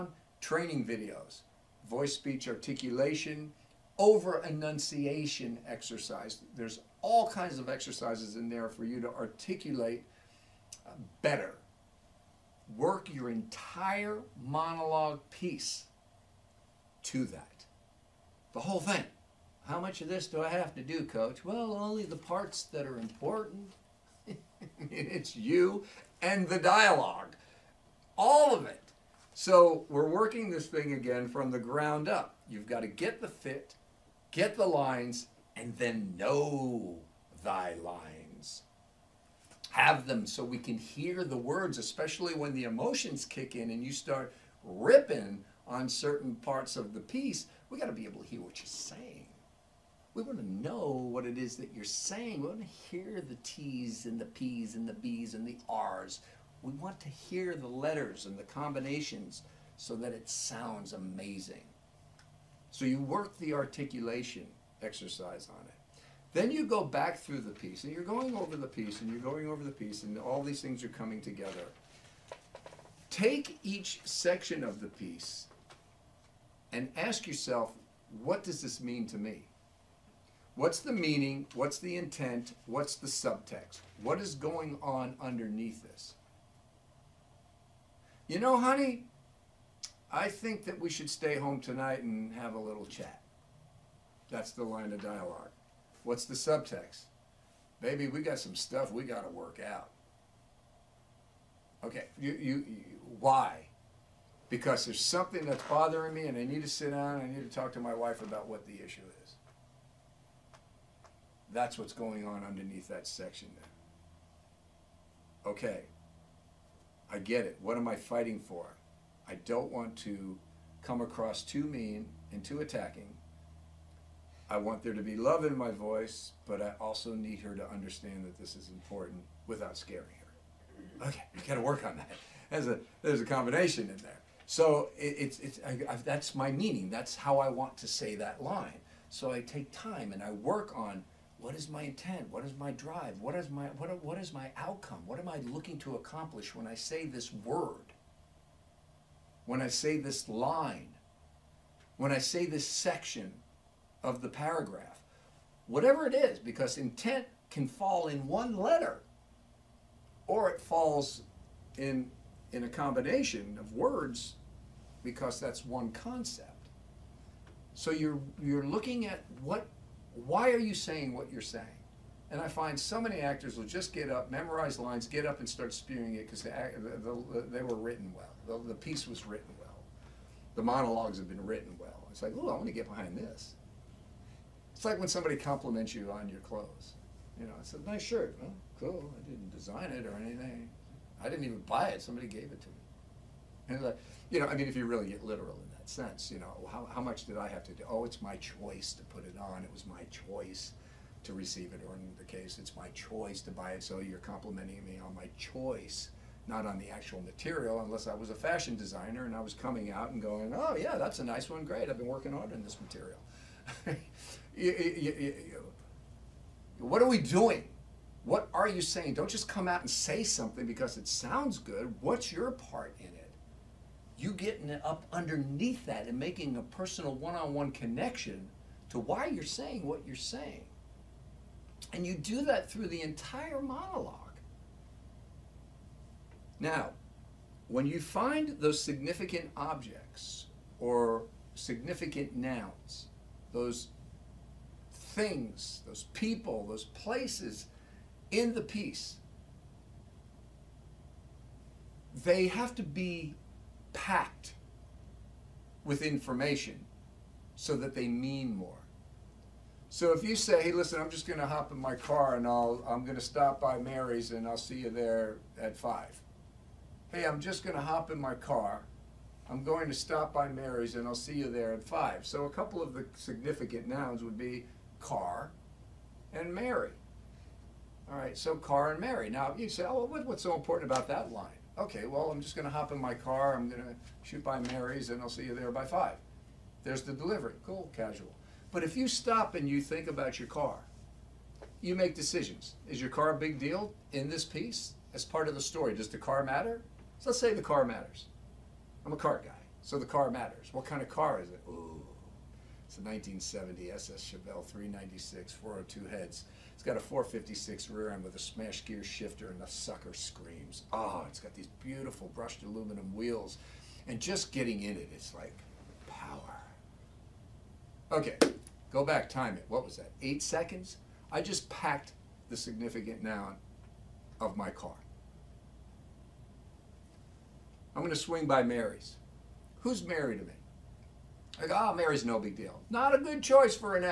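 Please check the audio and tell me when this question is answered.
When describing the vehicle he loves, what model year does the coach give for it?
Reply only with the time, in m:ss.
5:03.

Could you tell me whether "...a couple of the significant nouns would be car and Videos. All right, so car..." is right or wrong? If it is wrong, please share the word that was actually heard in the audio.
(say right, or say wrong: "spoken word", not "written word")
wrong: "Mary", not "Videos".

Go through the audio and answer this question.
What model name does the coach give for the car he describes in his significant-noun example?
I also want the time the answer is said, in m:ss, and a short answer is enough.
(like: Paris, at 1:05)
Chevelle, at 5:04.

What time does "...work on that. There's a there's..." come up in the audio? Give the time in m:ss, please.
2:11.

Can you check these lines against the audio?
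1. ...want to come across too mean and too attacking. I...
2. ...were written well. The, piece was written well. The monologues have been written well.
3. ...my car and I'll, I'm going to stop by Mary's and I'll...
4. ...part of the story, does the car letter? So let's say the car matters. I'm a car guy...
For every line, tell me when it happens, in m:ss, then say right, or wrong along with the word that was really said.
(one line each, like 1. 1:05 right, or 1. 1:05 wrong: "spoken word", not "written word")
1. 1:59 right
2. 2:57 right
3. 4:21 right
4. 4:55 wrong: "matter", not "letter".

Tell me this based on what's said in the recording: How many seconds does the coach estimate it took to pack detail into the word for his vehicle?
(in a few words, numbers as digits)
8 seconds.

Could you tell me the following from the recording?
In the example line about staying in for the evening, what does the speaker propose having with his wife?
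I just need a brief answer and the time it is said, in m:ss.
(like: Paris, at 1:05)
a little chat, at 1:32.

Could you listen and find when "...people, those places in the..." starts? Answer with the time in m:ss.
4:06.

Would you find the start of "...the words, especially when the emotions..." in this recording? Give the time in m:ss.
0:41.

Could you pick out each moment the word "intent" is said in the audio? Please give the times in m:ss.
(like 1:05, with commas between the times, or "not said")
1:21, 2:21, 2:36.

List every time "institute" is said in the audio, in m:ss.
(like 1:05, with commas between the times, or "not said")
not said.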